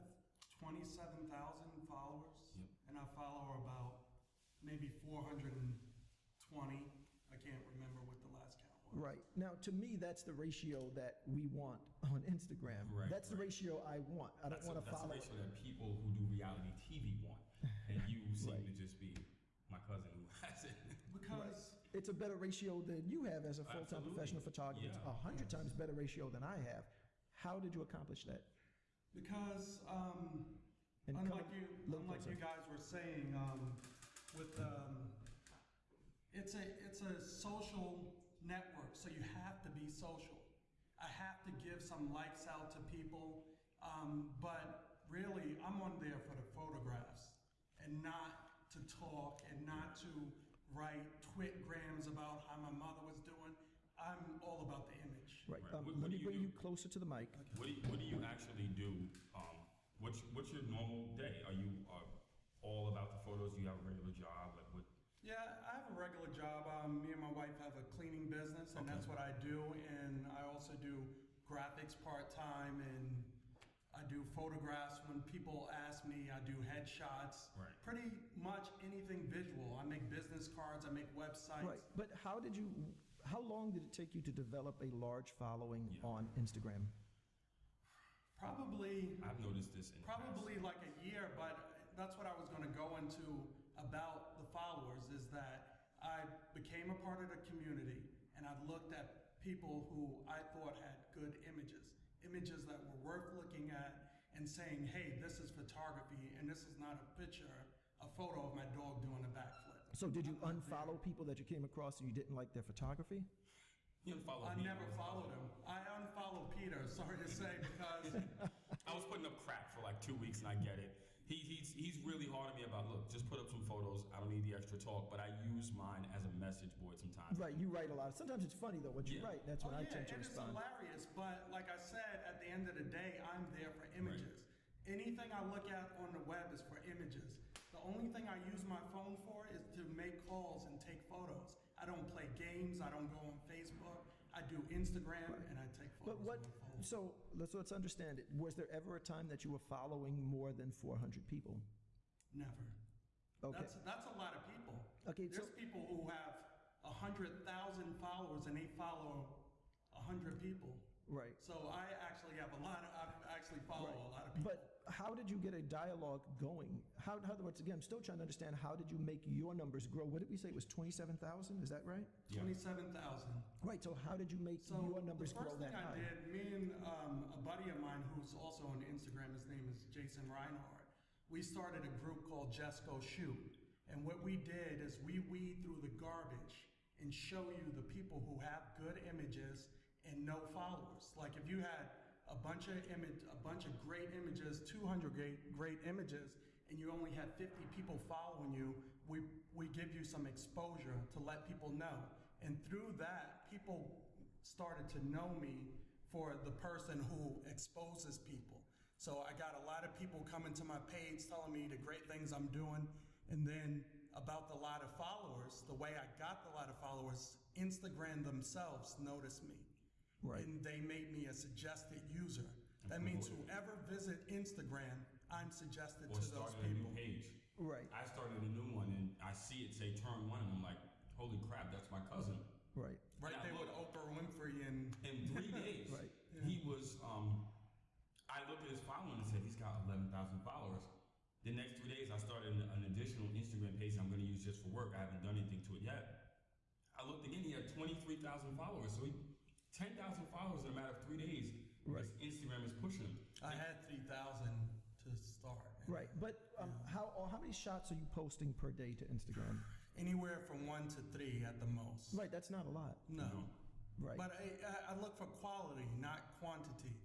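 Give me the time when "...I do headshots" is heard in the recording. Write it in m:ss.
1:16.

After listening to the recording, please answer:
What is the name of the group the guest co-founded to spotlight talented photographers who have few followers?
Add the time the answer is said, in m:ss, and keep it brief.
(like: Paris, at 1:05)
JustGoShoot, at 3:02.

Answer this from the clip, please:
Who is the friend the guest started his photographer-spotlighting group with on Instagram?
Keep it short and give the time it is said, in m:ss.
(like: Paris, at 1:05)
Jason Reinhardt, at 2:59.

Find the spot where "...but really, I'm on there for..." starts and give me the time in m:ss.
0:44.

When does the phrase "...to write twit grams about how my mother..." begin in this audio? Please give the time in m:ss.
0:49.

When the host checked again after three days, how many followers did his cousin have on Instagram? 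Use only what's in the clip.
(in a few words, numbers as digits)
23,000.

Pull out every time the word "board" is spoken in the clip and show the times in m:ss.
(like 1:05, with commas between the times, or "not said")
2:06.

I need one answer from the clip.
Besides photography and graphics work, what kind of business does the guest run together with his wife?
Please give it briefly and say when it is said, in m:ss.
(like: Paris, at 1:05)
Cleaning business, at 1:07.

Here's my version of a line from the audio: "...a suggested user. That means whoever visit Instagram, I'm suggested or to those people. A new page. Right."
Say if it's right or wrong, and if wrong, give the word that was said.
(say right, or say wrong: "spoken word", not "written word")
right.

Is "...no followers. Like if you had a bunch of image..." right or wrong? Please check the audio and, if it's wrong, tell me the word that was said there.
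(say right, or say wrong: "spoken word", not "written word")
right.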